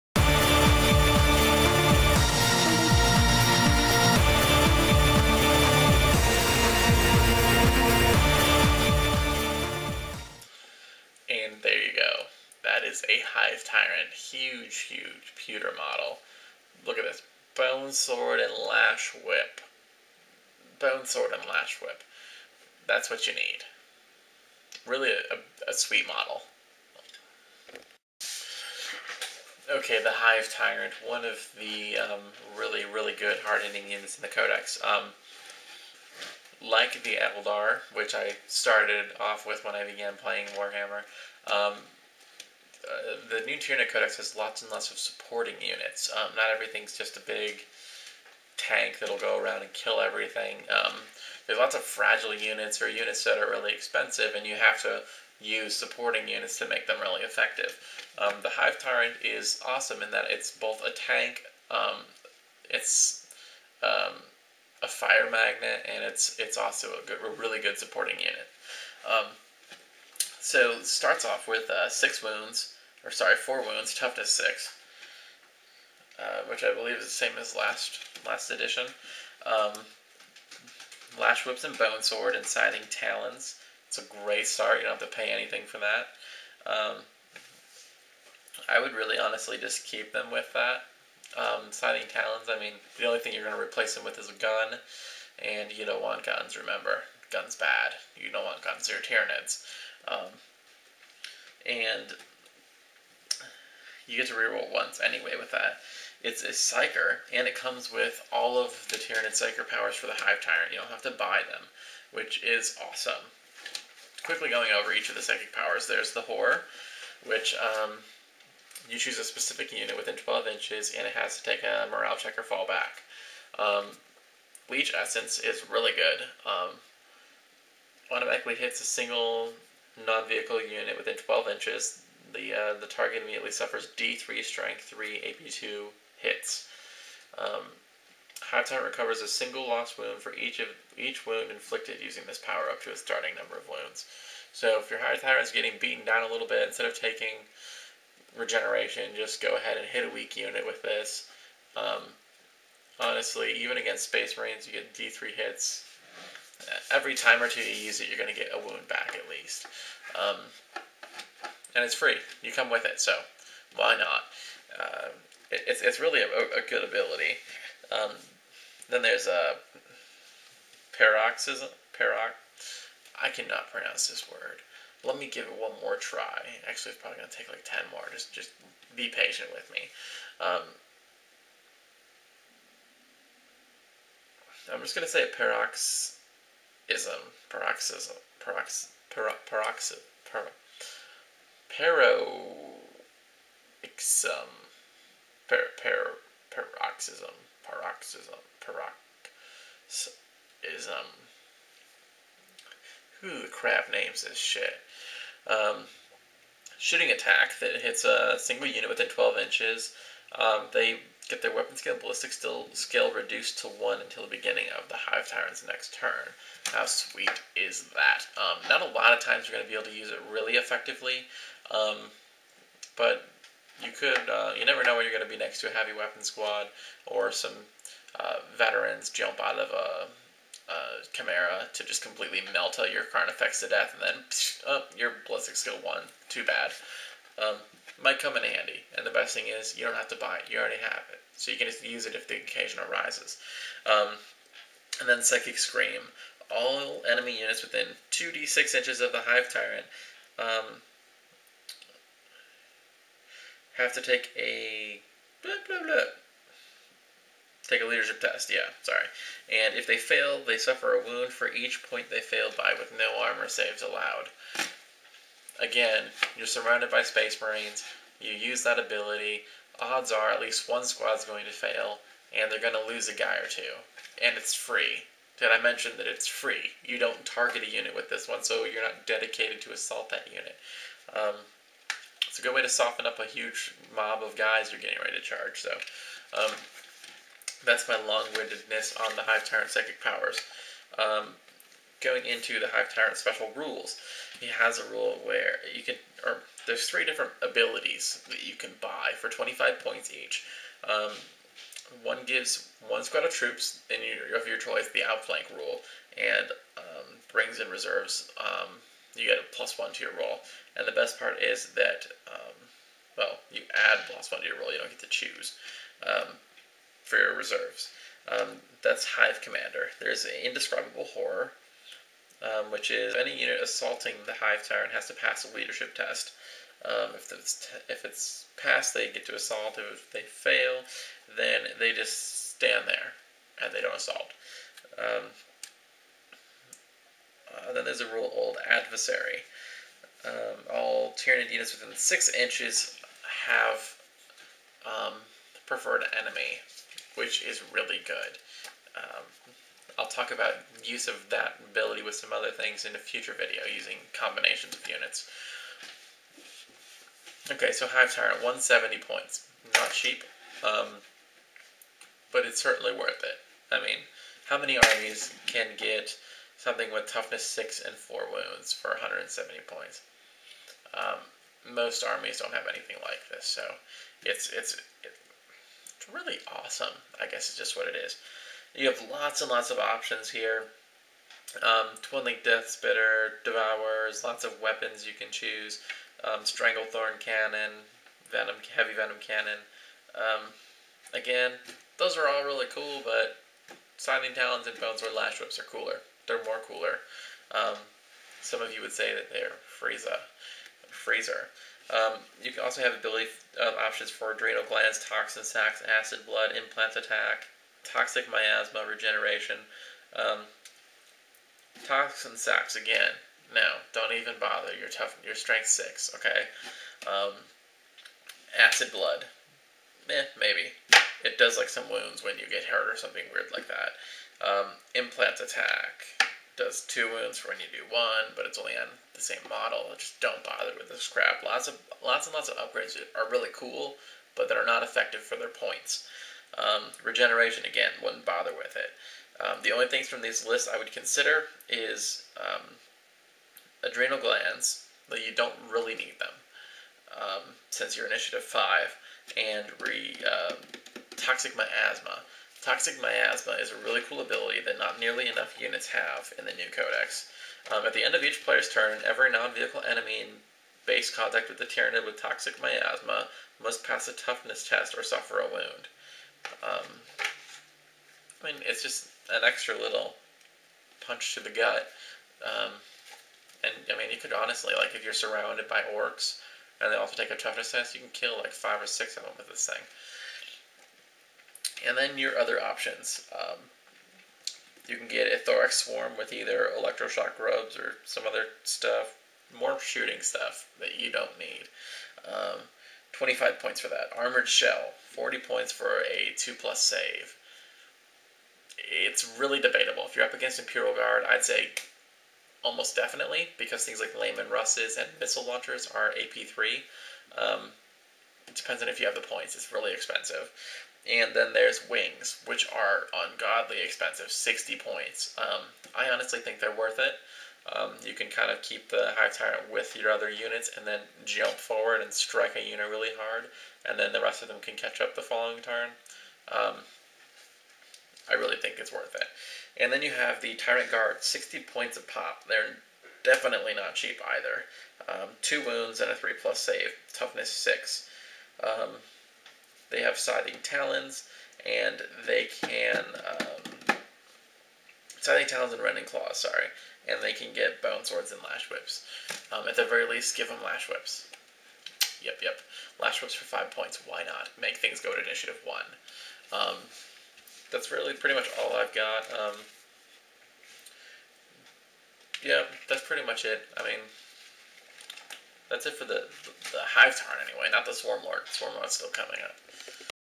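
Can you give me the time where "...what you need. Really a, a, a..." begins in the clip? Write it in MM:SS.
00:23.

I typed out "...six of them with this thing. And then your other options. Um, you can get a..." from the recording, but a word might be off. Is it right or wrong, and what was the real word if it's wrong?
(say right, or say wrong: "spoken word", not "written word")
right.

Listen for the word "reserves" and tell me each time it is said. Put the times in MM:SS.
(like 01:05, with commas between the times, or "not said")
05:07, 05:17.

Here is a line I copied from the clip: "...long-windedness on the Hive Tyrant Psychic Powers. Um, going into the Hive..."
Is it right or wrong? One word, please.
right.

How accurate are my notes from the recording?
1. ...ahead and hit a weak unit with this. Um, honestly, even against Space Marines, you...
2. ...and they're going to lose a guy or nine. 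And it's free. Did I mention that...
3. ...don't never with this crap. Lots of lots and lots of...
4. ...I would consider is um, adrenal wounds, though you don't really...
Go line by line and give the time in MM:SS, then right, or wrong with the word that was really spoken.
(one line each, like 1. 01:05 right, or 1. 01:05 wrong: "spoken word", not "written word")
1. 02:29 right
2. 04:32 wrong: "two", not "nine"
3. 07:10 wrong: "bother", not "never"
4. 07:20 wrong: "glands", not "wounds".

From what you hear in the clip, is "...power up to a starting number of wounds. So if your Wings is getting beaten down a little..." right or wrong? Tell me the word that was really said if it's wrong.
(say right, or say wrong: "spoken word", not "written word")
wrong: "Hatan", not "Wings".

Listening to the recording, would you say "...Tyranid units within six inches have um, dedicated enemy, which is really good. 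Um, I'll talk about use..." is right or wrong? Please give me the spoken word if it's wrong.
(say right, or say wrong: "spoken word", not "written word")
wrong: "preferred", not "dedicated".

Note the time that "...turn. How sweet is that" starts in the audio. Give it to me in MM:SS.
03:35.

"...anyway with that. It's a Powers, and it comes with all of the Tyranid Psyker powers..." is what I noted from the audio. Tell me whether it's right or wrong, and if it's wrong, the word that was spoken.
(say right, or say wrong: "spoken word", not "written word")
wrong: "Psyker", not "Powers".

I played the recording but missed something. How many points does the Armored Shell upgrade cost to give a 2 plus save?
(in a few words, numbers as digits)
40 points.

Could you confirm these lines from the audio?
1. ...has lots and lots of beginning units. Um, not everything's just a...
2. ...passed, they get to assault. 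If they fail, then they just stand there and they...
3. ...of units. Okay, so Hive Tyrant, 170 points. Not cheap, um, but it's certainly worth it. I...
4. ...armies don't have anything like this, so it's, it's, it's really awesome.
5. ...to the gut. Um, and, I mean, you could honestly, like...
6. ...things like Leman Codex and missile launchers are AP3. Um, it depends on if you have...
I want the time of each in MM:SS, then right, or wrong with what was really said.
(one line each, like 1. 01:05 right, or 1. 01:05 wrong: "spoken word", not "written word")
1. 00:44 wrong: "supporting", not "beginning"
2. 05:28 right
3. 05:54 right
4. 06:12 right
5. 07:51 right
6. 08:23 wrong: "Russes", not "Codex".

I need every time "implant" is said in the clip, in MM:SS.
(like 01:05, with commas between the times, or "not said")
06:46, 07:04.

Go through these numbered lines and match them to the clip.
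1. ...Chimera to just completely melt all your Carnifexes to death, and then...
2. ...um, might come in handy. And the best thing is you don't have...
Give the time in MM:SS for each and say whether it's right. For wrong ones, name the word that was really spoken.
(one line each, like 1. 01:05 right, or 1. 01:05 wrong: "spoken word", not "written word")
1. 03:51 right
2. 03:57 right.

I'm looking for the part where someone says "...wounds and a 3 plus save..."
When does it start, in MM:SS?
08:55.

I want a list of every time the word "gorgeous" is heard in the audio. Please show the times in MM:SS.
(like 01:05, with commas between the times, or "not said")
not said.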